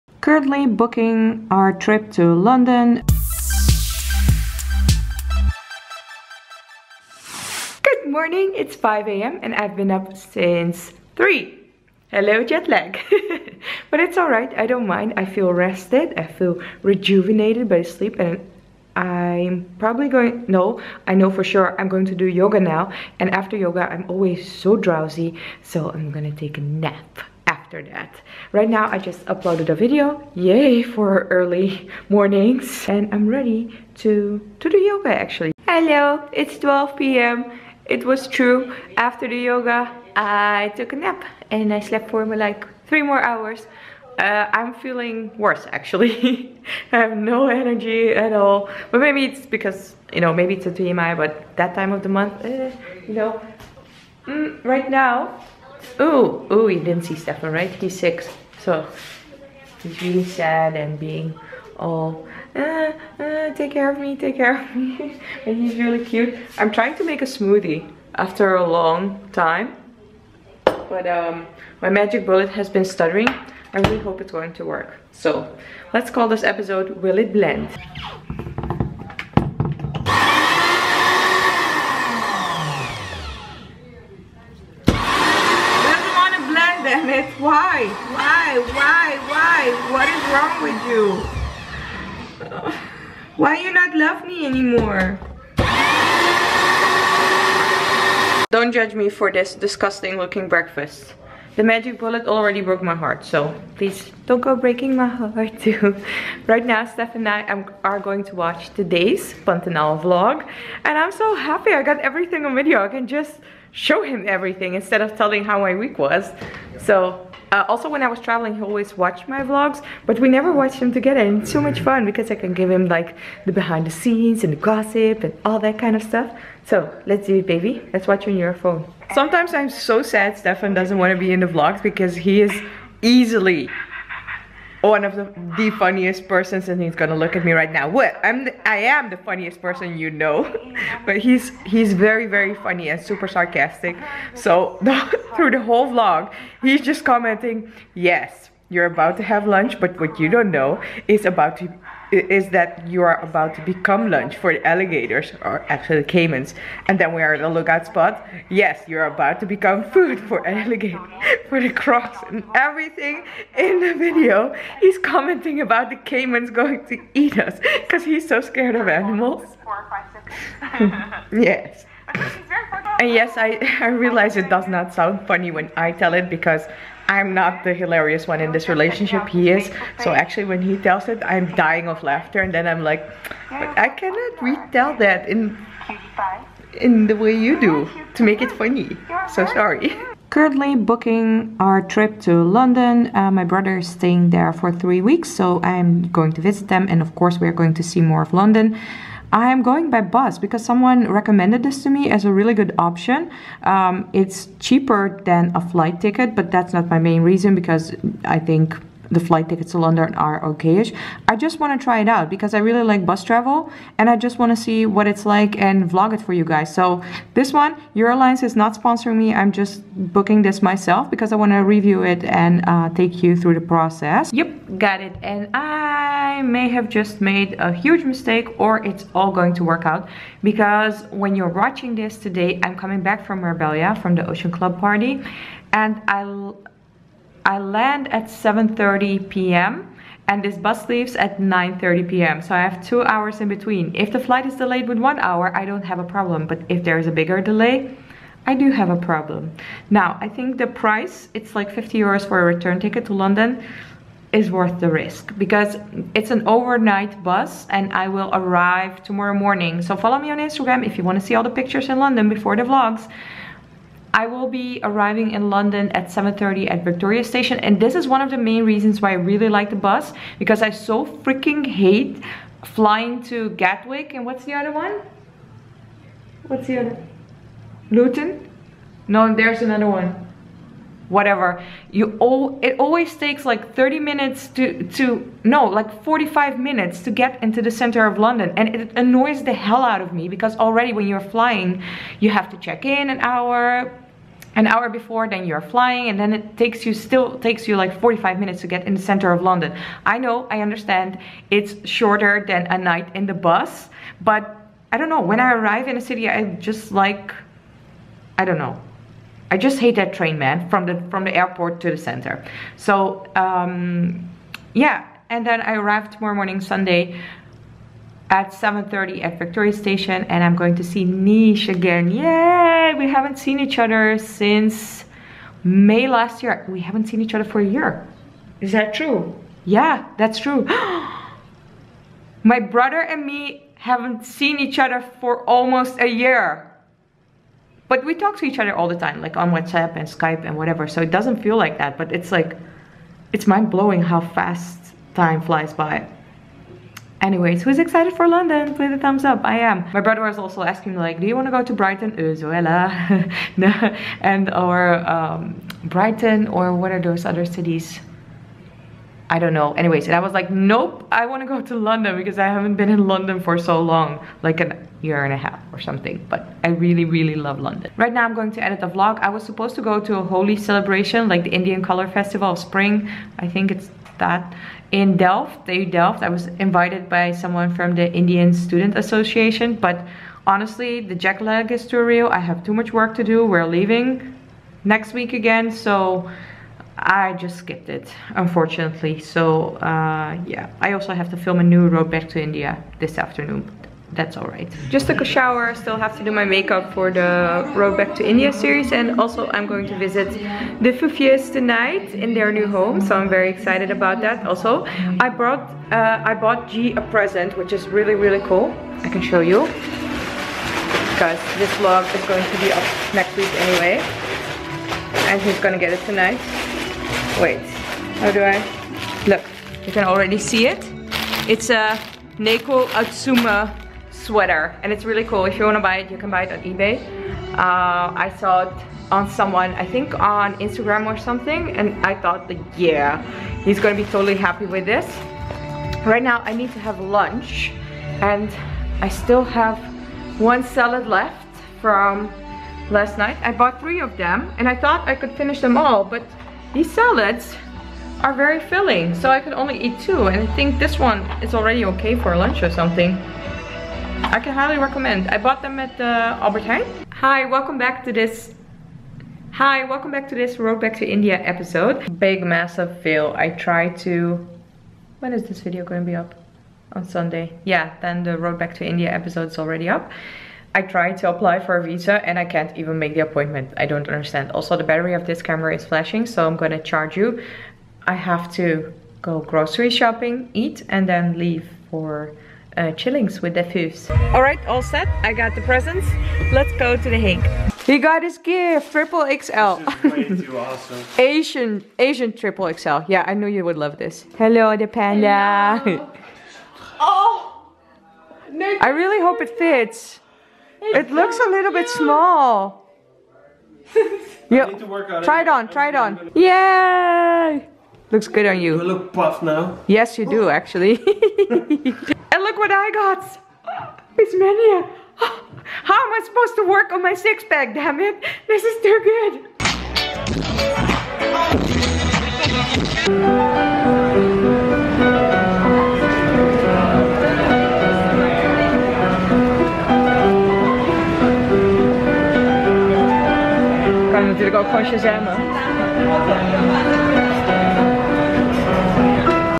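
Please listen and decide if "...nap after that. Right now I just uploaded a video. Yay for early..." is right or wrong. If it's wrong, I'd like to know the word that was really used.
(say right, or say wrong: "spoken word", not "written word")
right.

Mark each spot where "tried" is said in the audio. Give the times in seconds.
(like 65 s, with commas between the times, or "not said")
463 s, 470 s.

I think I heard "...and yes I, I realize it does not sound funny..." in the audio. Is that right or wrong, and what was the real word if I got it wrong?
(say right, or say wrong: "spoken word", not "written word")
right.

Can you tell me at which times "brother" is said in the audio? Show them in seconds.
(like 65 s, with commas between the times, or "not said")
193 s, 332 s, 350 s.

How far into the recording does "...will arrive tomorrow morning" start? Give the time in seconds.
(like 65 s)
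258 s.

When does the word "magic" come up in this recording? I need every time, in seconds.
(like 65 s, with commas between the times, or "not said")
71 s, 101 s.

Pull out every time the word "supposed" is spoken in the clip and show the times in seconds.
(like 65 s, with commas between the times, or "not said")
369 s, 516 s.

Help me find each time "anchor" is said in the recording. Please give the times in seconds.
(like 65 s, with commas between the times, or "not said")
not said.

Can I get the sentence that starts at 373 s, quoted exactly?
I think it's that in Delft, they Delft.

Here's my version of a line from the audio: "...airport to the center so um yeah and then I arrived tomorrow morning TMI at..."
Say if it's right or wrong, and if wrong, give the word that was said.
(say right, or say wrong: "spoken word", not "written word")
wrong: "Sunday", not "TMI".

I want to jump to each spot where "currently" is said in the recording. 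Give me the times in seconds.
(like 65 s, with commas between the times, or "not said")
0 s, 190 s.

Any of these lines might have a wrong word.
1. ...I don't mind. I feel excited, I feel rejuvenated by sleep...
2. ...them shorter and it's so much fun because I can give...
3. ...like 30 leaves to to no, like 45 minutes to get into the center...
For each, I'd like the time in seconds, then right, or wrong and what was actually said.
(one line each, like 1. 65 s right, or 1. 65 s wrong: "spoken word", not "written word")
1. 14 s wrong: "rested", not "excited"
2. 120 s wrong: "together", not "shorter"
3. 283 s wrong: "minutes", not "leaves".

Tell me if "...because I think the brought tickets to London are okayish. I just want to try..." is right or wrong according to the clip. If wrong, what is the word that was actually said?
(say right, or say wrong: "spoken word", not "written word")
wrong: "flight", not "brought".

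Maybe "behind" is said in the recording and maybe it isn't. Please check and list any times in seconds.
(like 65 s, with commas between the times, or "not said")
123 s.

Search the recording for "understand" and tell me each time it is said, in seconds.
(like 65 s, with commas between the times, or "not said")
300 s, 474 s.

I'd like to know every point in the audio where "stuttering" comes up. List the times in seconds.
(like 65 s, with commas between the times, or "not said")
72 s.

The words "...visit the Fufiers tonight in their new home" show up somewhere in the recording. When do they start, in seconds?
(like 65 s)
399 s.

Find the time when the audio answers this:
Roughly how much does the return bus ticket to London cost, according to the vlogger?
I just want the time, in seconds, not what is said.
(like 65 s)
251 s.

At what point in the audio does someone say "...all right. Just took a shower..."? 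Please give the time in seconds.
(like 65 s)
394 s.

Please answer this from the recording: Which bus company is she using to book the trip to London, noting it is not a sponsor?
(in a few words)
Alliance.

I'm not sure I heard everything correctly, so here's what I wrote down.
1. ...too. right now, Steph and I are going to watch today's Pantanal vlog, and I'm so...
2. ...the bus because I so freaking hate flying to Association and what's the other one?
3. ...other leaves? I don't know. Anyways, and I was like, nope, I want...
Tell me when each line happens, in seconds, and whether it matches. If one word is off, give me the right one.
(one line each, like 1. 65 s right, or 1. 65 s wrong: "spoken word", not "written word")
1. 105 s right
2. 269 s wrong: "Gatwick", not "Association"
3. 357 s wrong: "cities", not "leaves".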